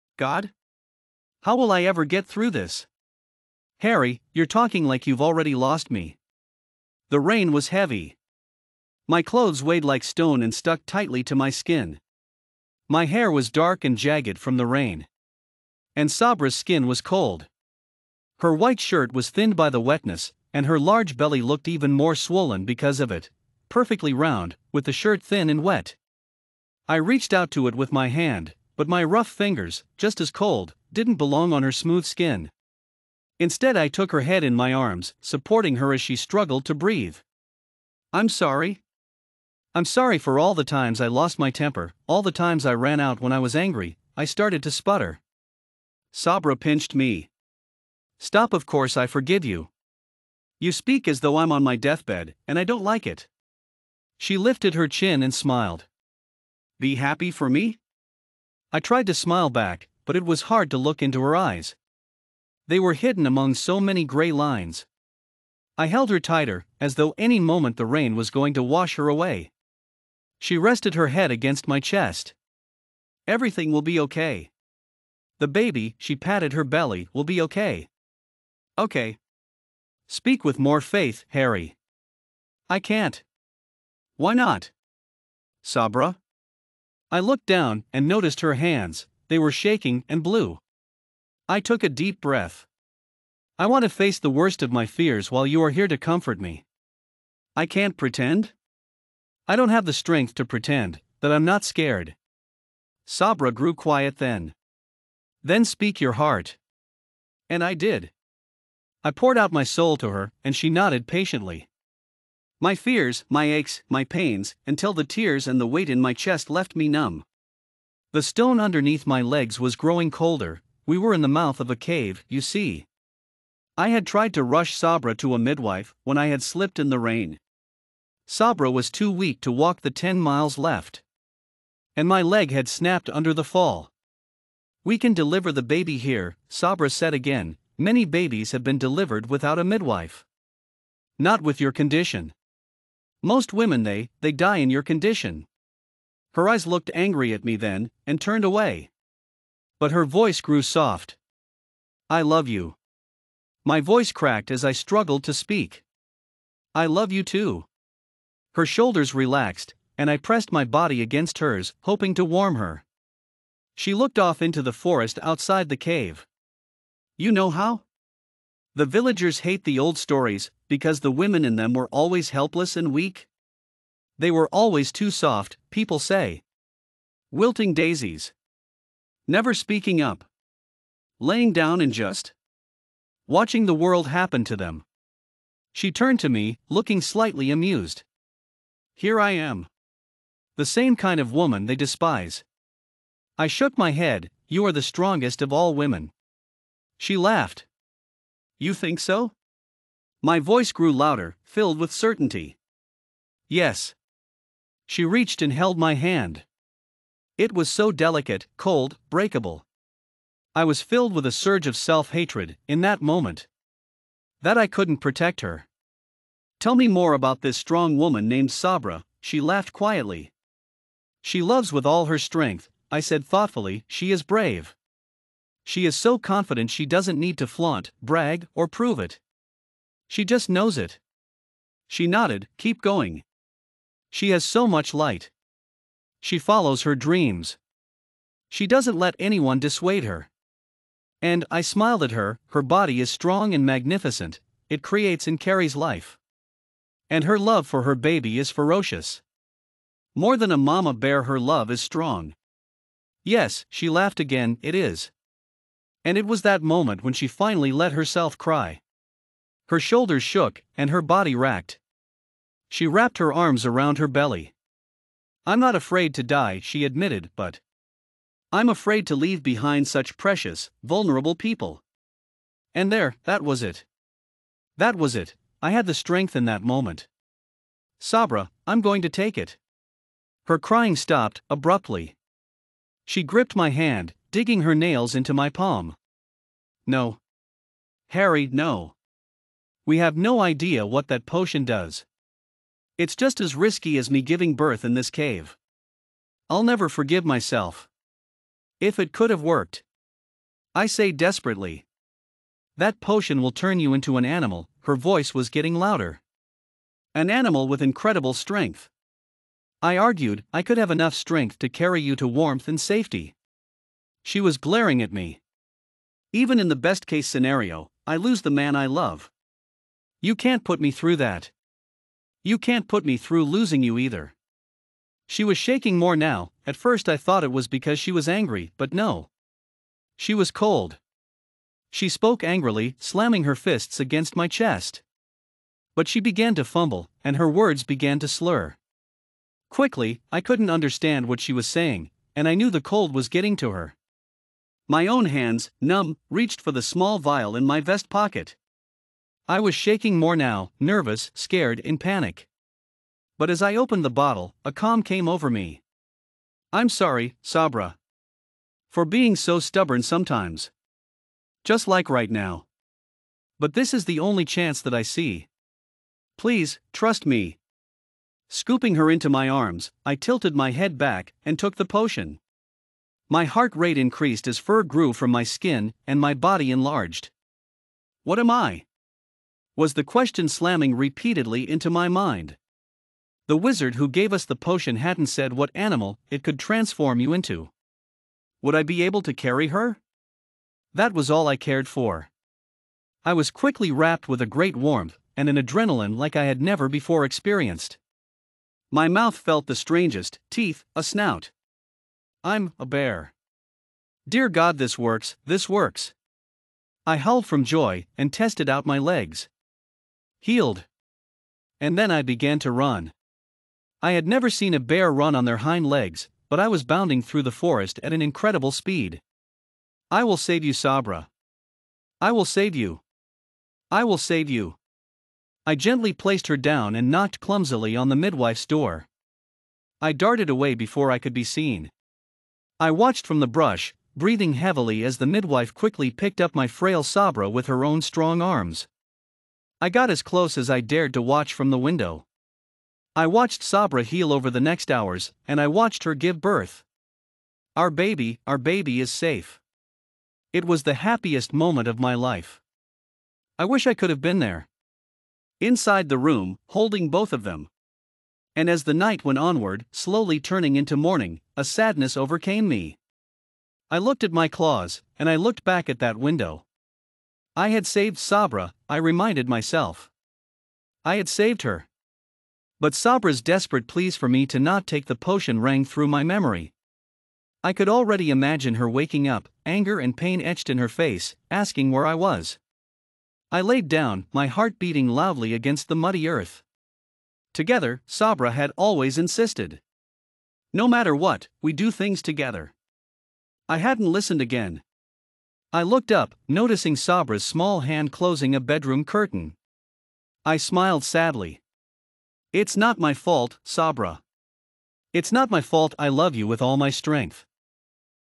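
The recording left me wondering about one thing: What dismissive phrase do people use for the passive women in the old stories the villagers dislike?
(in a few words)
Wilting daisies.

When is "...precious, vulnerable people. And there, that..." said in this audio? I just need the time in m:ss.
4:30.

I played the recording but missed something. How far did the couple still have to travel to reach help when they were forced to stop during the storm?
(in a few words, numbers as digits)
10 miles.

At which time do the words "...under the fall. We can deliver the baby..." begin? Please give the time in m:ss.
2:13.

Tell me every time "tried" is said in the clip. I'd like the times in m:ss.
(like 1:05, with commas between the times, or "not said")
0:58, 2:04.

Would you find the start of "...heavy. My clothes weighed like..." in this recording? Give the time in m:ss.
0:07.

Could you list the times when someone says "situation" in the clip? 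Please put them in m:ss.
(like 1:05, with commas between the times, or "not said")
not said.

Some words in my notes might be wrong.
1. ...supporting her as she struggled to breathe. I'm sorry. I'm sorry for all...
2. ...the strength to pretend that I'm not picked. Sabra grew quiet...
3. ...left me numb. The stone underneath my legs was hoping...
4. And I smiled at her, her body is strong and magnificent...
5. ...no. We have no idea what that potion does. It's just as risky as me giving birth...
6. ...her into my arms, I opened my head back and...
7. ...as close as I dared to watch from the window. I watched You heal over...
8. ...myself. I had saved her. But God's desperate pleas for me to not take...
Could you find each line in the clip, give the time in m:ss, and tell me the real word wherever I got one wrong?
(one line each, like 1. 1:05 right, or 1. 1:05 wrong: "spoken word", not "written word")
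1. 0:35 right
2. 1:39 wrong: "scared", not "picked"
3. 1:56 wrong: "growing", not "hoping"
4. 4:01 right
5. 4:48 right
6. 6:08 wrong: "tilted", not "opened"
7. 7:20 wrong: "Sabra", not "You"
8. 7:49 wrong: "Sabra", not "God".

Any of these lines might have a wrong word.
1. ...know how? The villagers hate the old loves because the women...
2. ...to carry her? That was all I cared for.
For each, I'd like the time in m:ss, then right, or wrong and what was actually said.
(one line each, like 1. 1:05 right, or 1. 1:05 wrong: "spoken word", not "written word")
1. 2:47 wrong: "stories", not "loves"
2. 6:29 right.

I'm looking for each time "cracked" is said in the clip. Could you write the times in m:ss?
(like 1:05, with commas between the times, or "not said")
2:34.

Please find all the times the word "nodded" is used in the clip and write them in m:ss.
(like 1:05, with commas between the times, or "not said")
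1:50, 3:52.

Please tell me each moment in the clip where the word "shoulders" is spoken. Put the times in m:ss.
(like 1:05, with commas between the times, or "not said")
2:38, 4:19.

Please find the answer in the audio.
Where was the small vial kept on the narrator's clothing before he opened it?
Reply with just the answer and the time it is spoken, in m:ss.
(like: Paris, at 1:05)
Vest pocket, at 5:47.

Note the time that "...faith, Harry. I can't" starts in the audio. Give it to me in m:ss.
1:20.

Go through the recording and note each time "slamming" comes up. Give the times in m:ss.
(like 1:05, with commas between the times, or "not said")
5:32, 6:20.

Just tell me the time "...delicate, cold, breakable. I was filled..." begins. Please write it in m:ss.
3:27.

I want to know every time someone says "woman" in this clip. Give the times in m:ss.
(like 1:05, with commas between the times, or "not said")
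3:11, 3:37.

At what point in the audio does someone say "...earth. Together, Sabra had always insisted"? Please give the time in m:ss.
8:06.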